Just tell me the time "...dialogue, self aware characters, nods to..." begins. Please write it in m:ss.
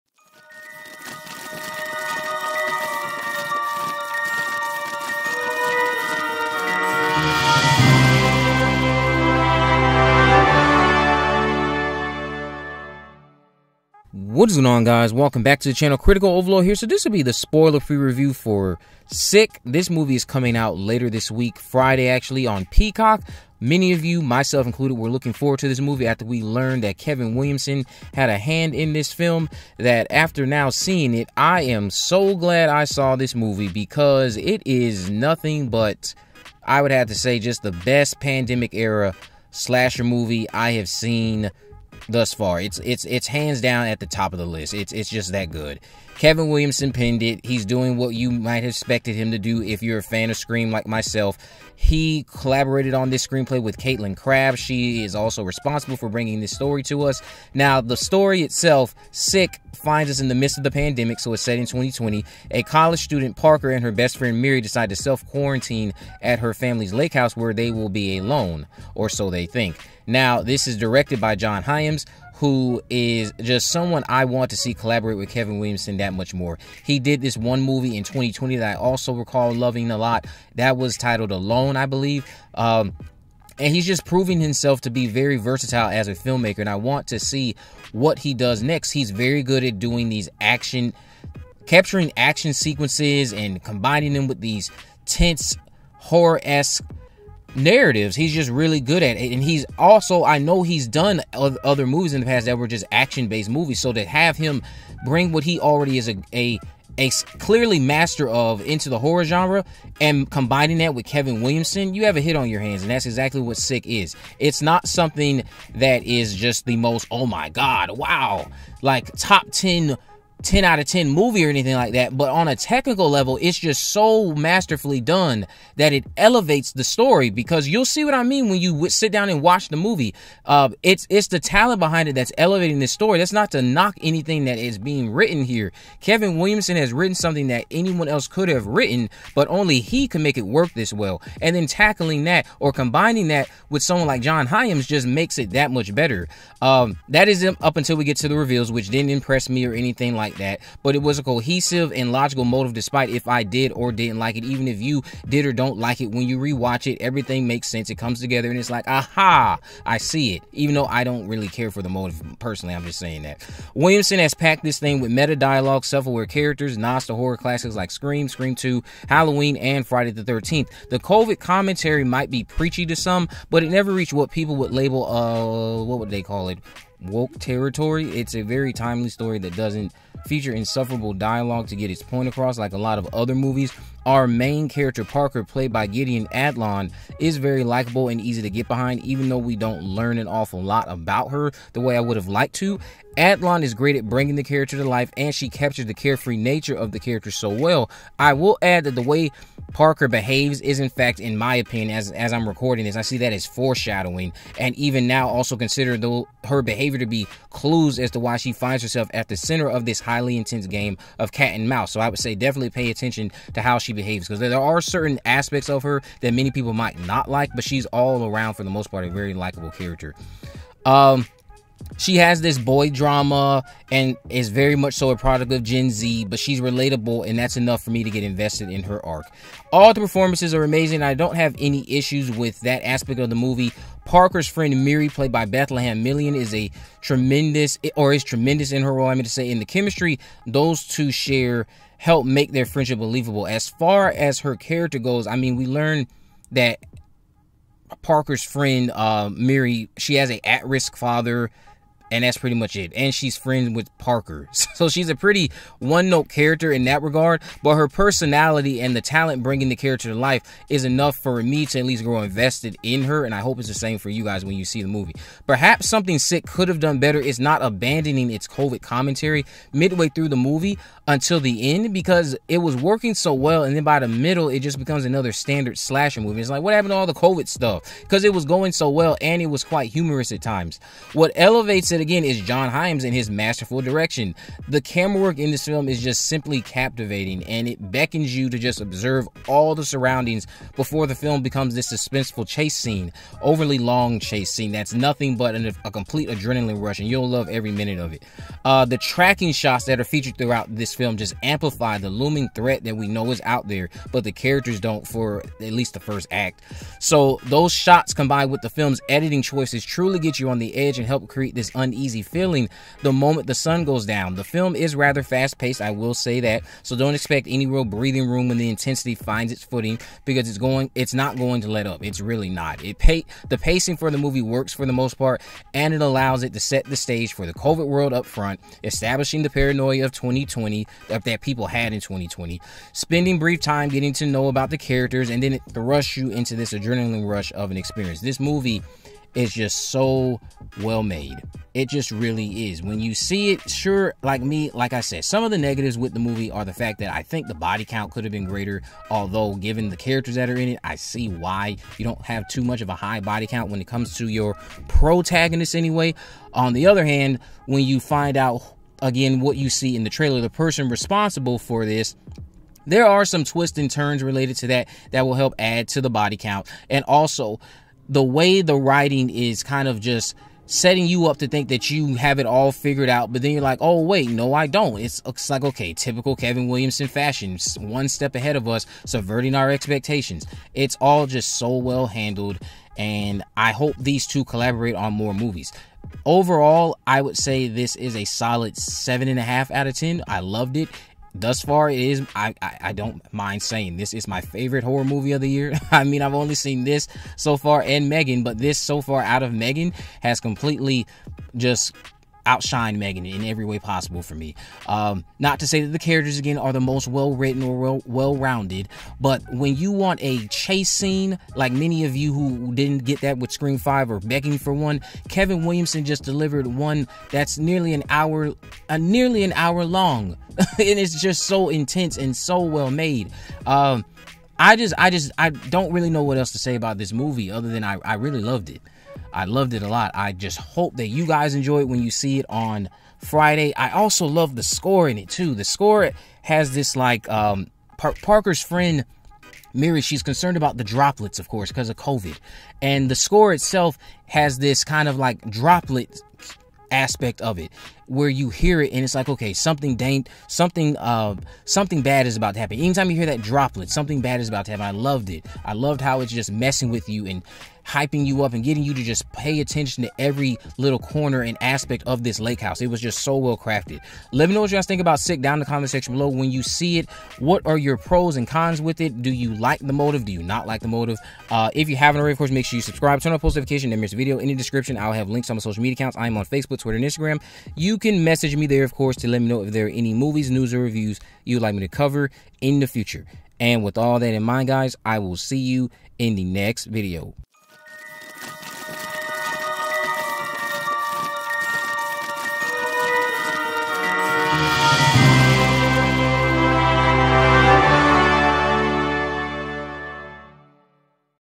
2:45.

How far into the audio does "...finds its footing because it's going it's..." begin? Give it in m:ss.
5:19.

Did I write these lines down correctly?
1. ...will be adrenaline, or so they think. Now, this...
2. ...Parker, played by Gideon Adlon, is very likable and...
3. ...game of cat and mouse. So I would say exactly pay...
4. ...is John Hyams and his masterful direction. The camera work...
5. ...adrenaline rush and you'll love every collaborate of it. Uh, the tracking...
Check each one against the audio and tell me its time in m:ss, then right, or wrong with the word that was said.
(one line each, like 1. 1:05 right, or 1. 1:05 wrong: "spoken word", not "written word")
1. 1:07 wrong: "alone", not "adrenaline"
2. 3:05 right
3. 3:30 wrong: "definitely", not "exactly"
4. 4:42 right
5. 4:56 wrong: "minute", not "collaborate".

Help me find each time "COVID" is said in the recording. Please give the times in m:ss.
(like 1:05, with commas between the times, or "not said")
2:50, 4:28, 4:37, 5:27, 7:21.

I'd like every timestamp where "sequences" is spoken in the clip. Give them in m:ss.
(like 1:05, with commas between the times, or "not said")
1:32.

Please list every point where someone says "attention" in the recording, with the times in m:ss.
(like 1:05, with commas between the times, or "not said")
3:32, 7:39.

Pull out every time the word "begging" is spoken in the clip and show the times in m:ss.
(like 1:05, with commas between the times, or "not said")
6:54.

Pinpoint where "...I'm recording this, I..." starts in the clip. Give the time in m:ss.
3:22.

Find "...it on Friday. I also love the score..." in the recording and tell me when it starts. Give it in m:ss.
7:12.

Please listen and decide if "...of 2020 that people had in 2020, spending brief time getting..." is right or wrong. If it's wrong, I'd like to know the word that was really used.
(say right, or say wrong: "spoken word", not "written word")
right.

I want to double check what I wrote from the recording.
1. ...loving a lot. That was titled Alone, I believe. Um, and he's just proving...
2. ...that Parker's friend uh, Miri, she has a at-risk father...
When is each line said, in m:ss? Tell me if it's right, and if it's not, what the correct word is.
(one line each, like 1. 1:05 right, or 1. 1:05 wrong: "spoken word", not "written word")
1. 1:19 right
2. 4:06 right.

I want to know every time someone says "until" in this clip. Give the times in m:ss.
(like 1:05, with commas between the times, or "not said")
2:27, 4:31.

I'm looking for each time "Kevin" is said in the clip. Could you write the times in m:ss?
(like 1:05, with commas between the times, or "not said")
0:26, 0:46, 1:15, 1:51, 2:16, 6:16, 6:55.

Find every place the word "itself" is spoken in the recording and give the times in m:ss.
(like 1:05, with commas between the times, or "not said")
0:58, 7:23.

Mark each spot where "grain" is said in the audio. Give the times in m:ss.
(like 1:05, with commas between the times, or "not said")
not said.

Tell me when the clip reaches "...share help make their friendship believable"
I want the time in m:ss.
4:01.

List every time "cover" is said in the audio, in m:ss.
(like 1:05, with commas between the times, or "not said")
8:01.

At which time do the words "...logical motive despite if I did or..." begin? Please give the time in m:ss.
2:32.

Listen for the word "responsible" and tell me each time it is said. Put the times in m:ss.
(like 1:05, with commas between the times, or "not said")
0:55, 6:00.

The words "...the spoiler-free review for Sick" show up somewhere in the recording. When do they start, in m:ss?
0:17.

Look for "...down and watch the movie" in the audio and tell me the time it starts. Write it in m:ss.
2:09.